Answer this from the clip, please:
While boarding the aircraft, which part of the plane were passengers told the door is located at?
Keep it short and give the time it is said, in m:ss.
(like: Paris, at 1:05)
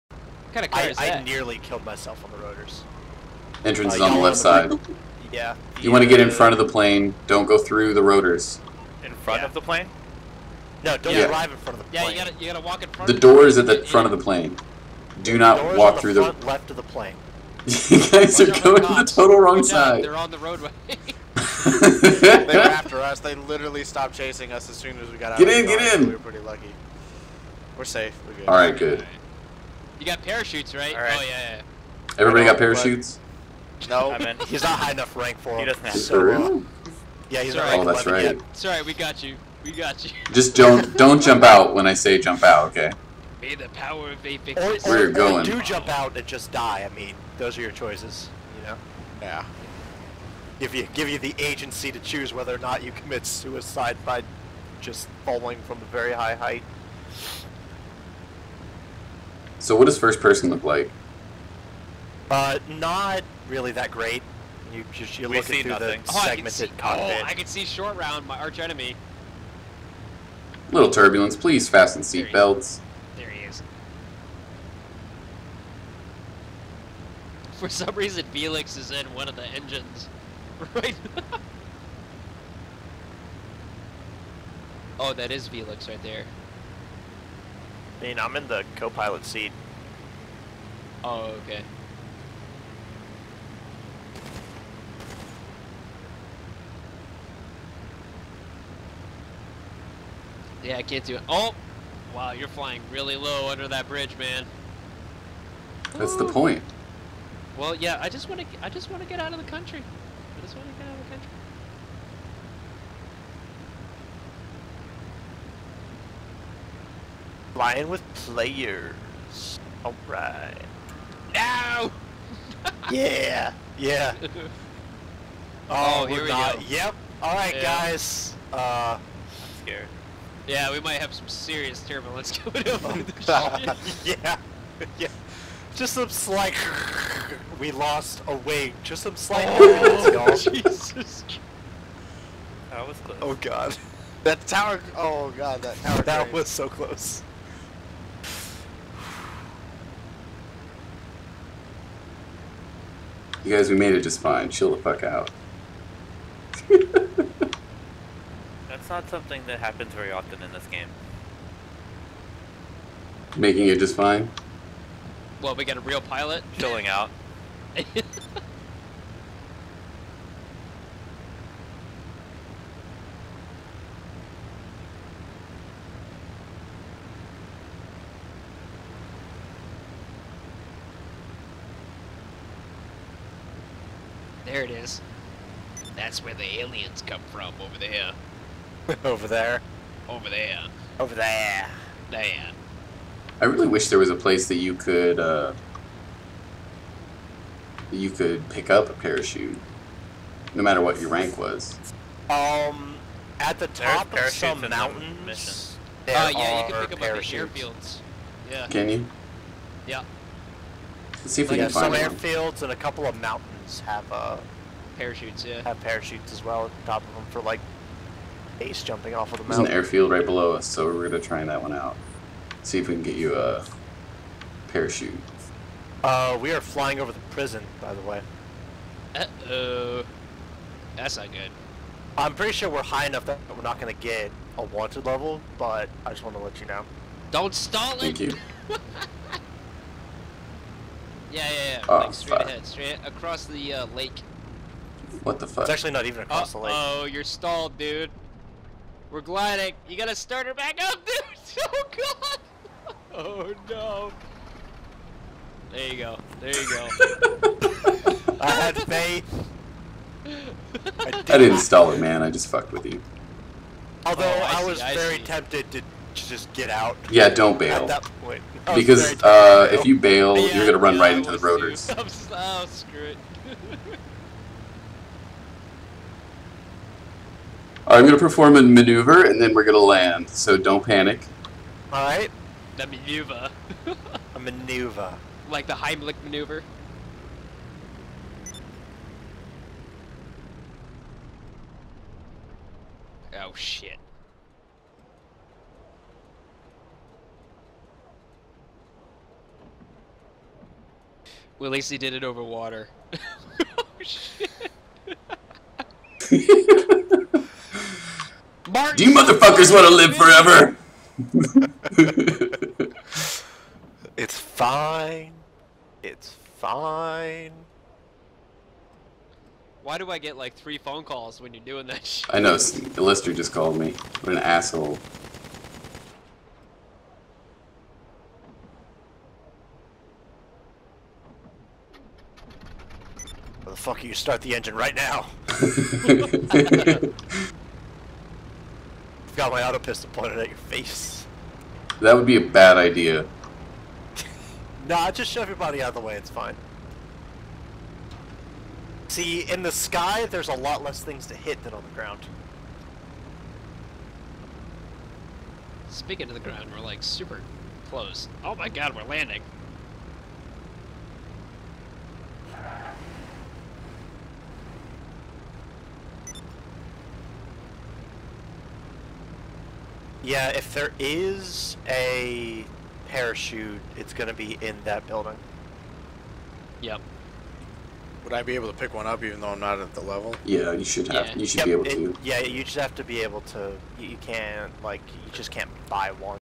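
The front, at 0:13.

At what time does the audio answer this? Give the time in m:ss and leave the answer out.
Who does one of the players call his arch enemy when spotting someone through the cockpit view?
1:07.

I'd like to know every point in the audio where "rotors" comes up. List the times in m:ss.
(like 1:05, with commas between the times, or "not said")
0:02, 0:08, 4:31.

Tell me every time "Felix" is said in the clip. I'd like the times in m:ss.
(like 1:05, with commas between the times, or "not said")
1:18, 1:25.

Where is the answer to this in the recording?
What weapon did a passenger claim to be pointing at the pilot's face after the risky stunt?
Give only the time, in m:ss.
5:39.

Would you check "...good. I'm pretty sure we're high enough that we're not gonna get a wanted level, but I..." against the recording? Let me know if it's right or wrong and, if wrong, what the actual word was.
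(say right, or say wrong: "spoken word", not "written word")
right.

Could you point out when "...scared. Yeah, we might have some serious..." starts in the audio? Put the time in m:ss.
2:09.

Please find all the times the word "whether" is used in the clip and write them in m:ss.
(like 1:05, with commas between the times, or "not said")
0:52.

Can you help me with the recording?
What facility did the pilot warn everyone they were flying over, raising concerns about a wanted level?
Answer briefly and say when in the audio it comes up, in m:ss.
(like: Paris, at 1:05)
The prison, at 3:46.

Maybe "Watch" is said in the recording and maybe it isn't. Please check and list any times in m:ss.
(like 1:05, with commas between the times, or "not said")
0:18.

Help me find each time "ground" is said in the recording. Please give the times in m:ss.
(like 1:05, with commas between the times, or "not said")
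5:51, 5:56.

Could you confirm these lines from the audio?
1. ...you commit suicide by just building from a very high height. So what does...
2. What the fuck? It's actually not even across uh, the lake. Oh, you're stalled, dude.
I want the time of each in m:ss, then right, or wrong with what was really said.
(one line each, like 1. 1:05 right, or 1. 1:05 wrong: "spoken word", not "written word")
1. 0:52 wrong: "falling", not "building"
2. 4:05 right.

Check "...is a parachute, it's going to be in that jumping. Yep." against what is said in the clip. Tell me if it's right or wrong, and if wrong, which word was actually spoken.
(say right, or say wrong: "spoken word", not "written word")
wrong: "building", not "jumping".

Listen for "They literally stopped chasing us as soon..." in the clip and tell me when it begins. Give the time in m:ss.
0:23.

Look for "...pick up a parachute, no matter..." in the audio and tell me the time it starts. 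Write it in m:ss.
3:18.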